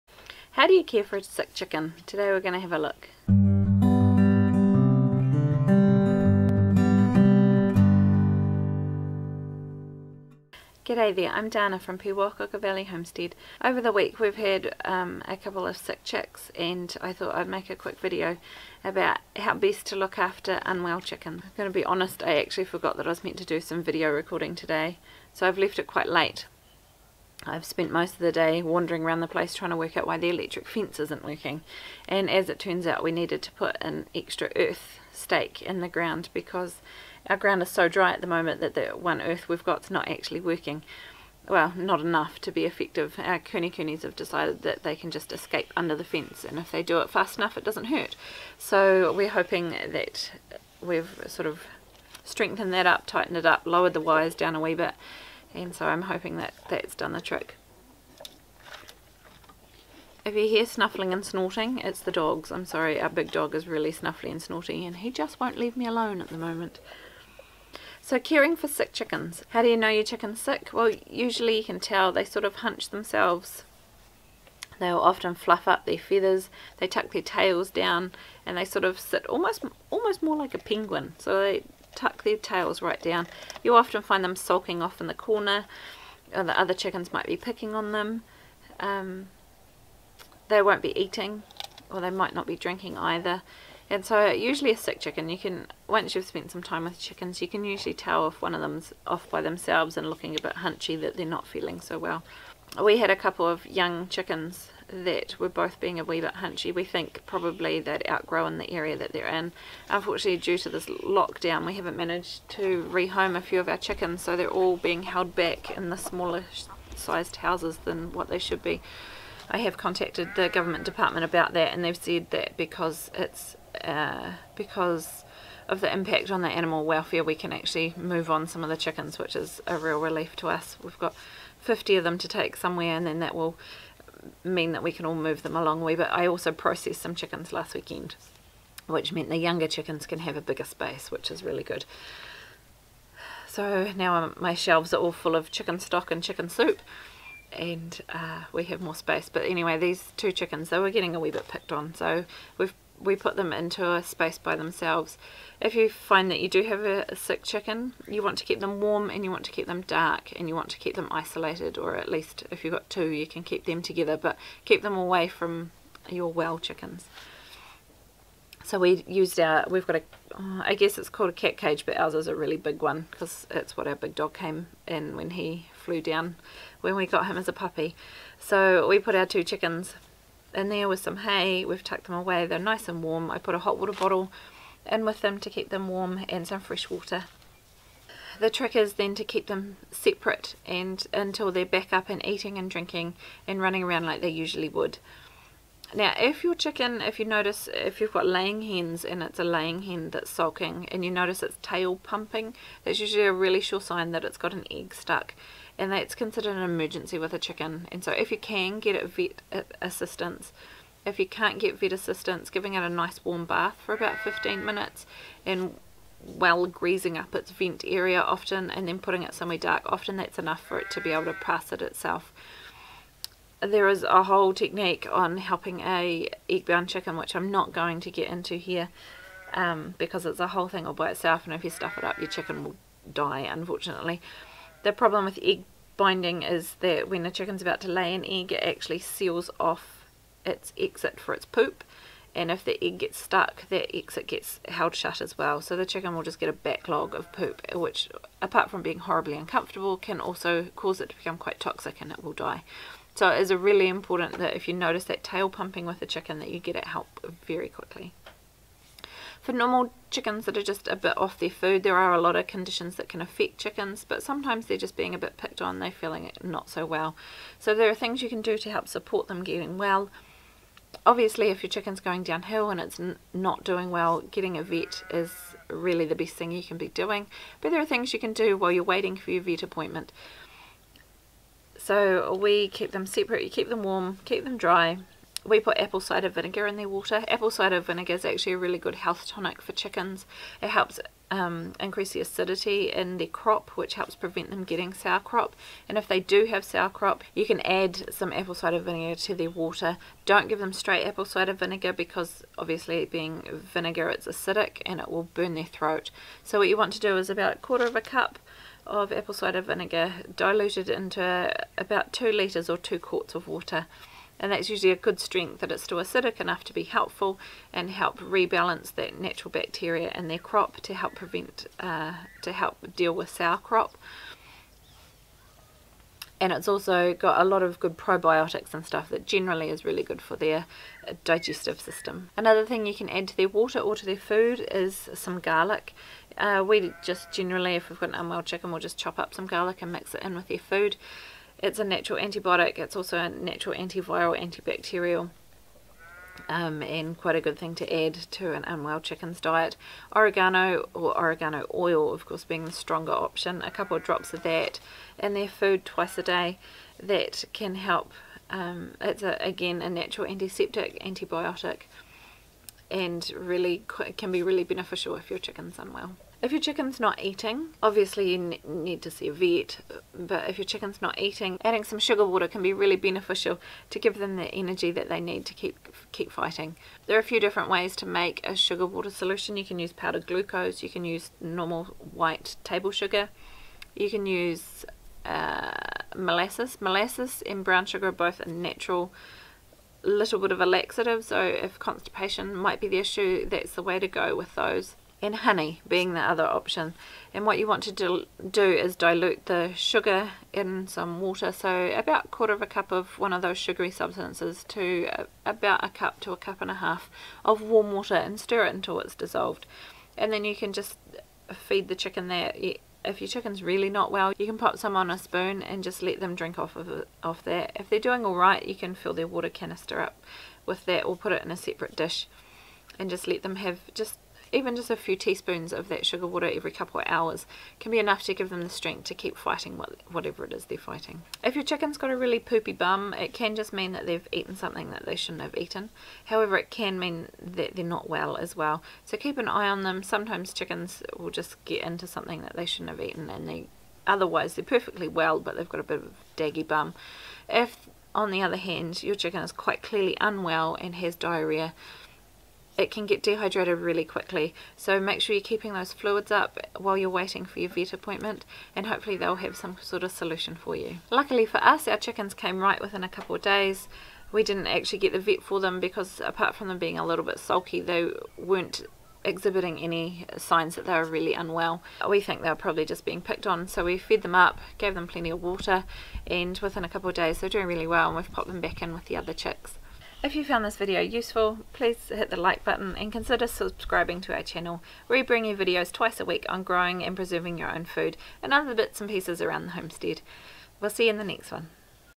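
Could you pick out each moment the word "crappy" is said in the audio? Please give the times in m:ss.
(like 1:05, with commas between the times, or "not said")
not said.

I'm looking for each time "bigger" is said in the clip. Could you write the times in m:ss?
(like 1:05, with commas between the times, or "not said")
2:20.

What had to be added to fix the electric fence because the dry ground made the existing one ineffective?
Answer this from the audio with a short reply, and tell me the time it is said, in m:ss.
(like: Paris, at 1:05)
an extra earth stake, at 0:33.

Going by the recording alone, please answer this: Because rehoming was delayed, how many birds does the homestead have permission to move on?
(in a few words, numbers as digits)
50.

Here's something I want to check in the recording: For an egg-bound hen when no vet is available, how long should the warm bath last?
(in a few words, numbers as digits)
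15 minutes.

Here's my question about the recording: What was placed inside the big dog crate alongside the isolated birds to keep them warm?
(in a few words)
a hot water bottle.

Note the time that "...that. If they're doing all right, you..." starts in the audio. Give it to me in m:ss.
6:57.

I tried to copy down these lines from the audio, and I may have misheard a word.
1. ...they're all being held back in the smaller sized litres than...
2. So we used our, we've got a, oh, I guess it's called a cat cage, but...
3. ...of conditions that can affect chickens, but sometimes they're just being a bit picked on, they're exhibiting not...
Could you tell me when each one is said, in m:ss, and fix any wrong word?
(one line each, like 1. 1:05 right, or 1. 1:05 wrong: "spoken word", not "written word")
1. 1:54 wrong: "houses", not "litres"
2. 2:48 right
3. 4:22 wrong: "feeling", not "exhibiting".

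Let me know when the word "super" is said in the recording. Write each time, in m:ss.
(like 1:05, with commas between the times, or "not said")
not said.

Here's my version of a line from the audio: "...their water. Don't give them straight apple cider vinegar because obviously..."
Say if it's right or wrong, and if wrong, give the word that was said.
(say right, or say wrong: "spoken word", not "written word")
right.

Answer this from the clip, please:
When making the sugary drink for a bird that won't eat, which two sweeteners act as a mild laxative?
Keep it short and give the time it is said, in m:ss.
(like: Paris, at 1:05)
molasses and brown sugar, at 6:26.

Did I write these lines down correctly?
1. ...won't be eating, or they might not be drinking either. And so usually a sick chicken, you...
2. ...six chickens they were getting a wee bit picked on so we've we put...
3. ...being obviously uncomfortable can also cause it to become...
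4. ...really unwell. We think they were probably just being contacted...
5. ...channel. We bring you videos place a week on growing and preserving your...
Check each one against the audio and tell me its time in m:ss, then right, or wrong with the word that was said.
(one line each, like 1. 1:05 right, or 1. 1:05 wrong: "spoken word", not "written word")
1. 1:30 right
2. 2:30 wrong: "two", not "six"
3. 4:08 wrong: "horribly", not "obviously"
4. 7:51 wrong: "picked", not "contacted"
5. 8:04 wrong: "twice", not "place".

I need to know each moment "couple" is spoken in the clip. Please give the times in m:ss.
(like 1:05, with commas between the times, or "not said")
0:15, 1:43, 5:53, 7:06, 7:43, 7:56.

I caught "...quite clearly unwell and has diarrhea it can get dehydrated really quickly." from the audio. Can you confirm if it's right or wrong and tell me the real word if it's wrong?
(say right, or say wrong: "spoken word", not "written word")
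right.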